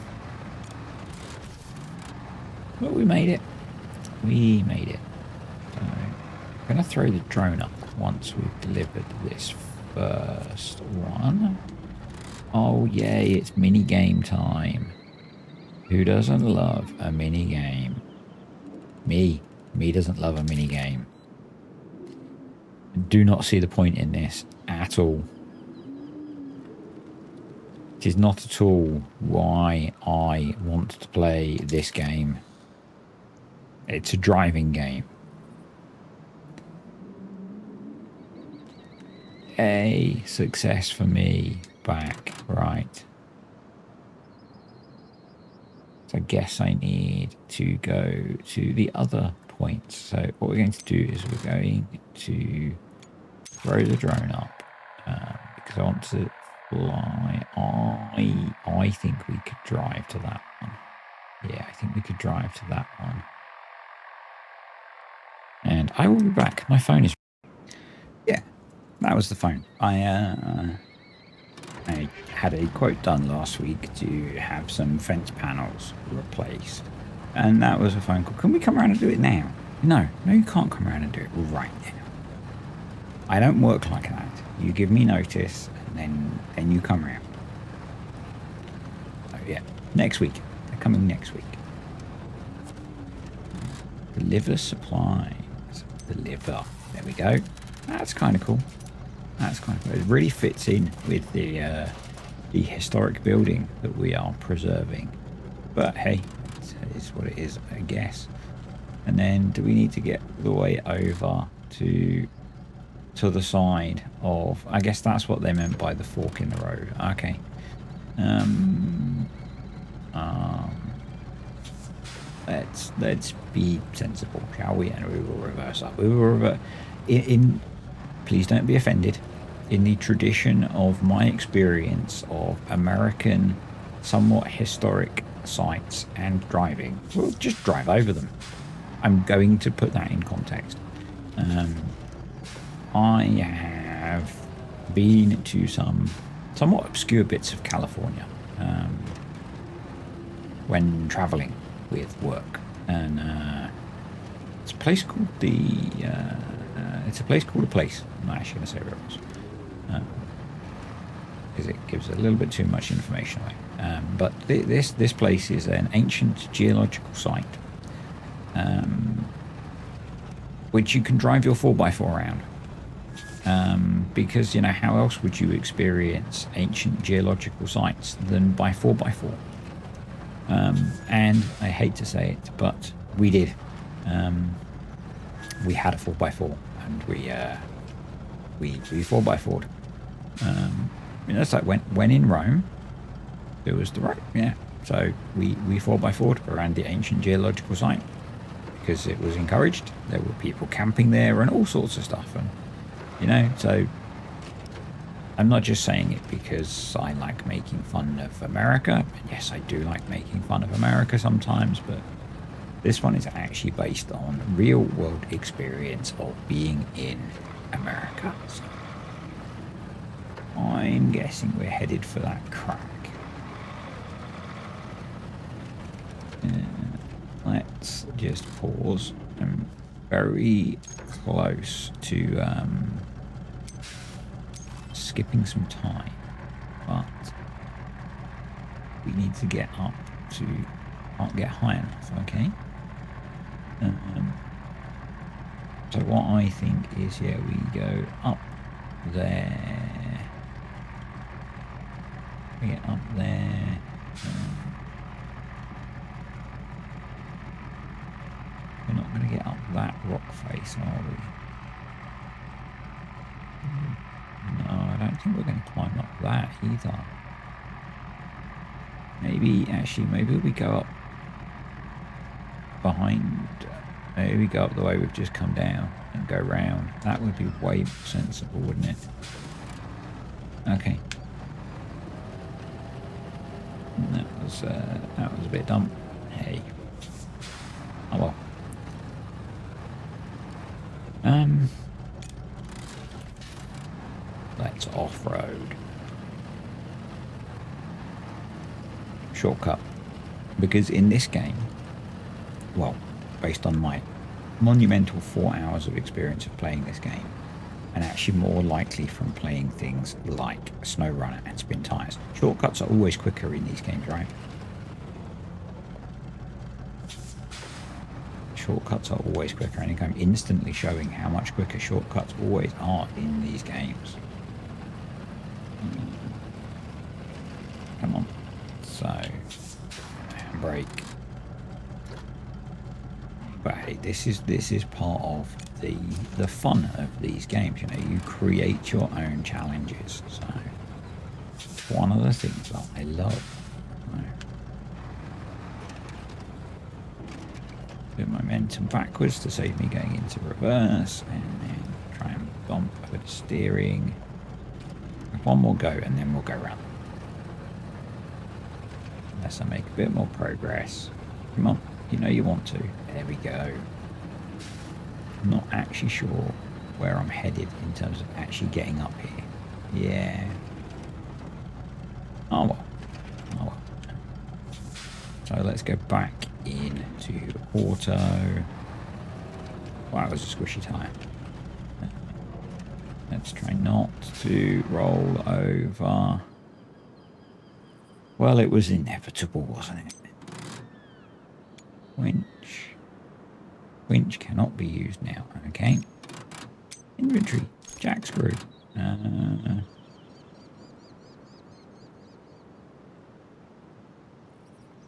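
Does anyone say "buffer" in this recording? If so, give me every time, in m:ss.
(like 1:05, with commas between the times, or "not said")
not said.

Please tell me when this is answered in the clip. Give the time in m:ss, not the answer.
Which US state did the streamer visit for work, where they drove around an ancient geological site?
2:27.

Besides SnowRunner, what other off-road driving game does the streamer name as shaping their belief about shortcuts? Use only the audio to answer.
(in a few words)
Spintires.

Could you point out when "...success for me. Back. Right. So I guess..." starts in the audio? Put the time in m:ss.
0:40.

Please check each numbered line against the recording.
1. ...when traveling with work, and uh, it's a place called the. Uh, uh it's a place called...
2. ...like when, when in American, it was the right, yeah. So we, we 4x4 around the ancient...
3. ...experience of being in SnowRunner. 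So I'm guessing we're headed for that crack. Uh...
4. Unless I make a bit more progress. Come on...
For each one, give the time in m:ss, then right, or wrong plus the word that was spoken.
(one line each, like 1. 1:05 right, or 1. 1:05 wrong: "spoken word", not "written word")
1. 2:30 right
2. 3:11 wrong: "Rome", not "American"
3. 3:35 wrong: "America", not "SnowRunner"
4. 5:59 right.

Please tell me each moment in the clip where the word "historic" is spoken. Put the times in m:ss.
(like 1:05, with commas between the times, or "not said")
1:42, 2:14.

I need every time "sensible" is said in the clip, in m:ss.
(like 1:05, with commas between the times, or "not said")
2:03, 4:37.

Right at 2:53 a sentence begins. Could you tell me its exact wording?
Um, because you know how else would you experience ancient geological sites than by four by four?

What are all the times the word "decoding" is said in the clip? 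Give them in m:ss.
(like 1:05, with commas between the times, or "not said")
not said.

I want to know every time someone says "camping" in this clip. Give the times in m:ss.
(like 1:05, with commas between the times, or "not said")
3:20.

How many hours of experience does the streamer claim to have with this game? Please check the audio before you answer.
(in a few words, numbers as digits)
4.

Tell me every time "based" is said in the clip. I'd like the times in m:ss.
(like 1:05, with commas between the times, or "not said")
3:33, 5:03.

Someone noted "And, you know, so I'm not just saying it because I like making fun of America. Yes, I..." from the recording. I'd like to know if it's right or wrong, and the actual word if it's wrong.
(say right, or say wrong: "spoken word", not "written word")
right.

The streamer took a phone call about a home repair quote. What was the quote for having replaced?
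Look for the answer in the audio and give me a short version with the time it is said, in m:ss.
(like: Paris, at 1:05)
Fence panels, at 1:14.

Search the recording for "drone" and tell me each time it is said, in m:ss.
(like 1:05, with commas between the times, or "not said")
0:07, 0:53.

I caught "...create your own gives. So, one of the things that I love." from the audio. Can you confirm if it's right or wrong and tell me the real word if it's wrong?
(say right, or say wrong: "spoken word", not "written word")
wrong: "challenges", not "gives".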